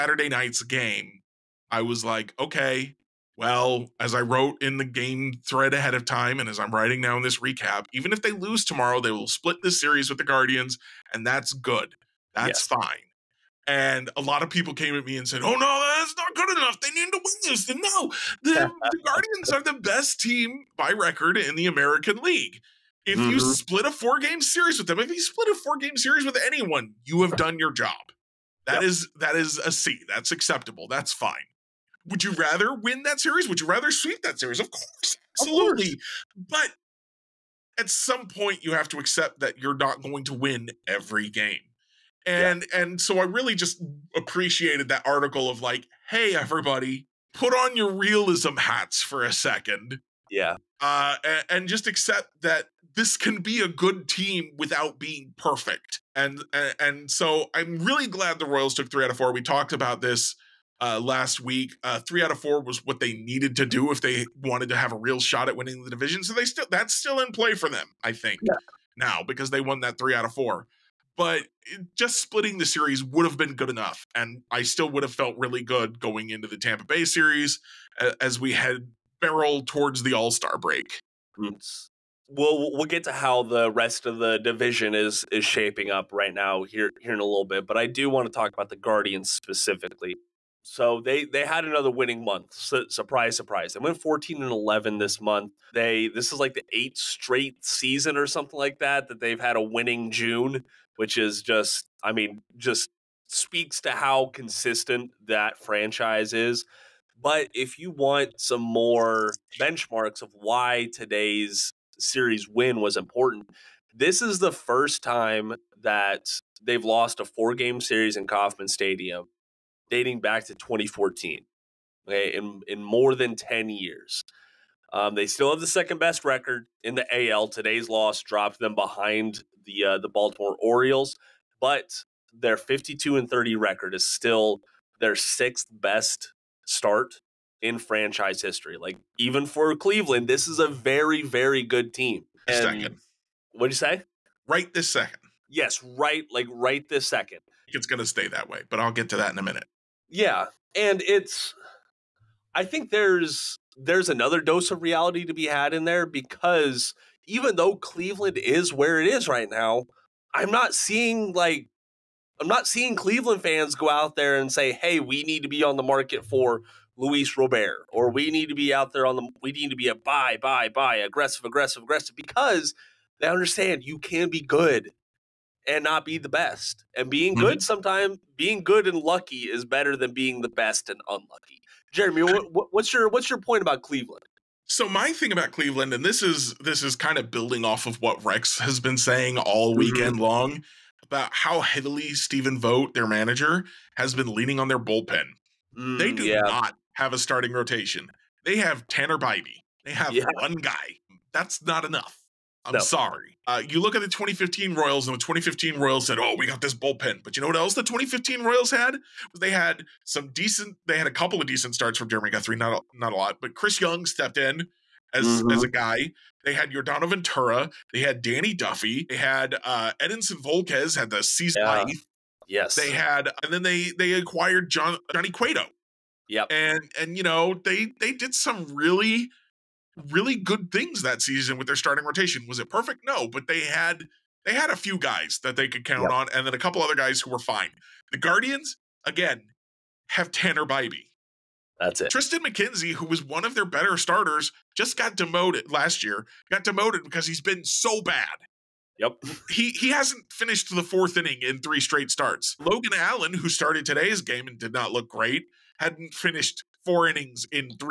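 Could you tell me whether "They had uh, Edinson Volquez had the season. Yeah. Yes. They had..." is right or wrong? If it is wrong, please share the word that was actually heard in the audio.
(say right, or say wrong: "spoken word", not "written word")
right.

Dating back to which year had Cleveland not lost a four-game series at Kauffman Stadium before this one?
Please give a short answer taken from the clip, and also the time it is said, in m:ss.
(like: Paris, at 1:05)
2014, at 2:00.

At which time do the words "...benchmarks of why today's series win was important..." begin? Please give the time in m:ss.
1:49.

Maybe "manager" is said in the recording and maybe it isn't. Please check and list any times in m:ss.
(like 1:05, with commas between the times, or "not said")
3:13.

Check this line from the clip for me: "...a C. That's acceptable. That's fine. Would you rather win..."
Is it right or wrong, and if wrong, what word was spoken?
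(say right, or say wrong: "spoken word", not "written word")
right.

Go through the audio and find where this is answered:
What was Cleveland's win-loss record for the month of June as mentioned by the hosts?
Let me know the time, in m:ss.
1:34.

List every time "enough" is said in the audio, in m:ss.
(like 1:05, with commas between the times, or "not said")
0:16, 1:13, 3:21.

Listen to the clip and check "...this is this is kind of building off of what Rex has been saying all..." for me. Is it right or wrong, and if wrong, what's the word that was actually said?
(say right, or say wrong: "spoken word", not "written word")
right.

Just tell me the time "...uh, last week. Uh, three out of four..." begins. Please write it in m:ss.
1:00.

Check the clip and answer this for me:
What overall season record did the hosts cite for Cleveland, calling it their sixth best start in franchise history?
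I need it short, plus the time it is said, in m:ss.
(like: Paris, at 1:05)
52-30, at 2:12.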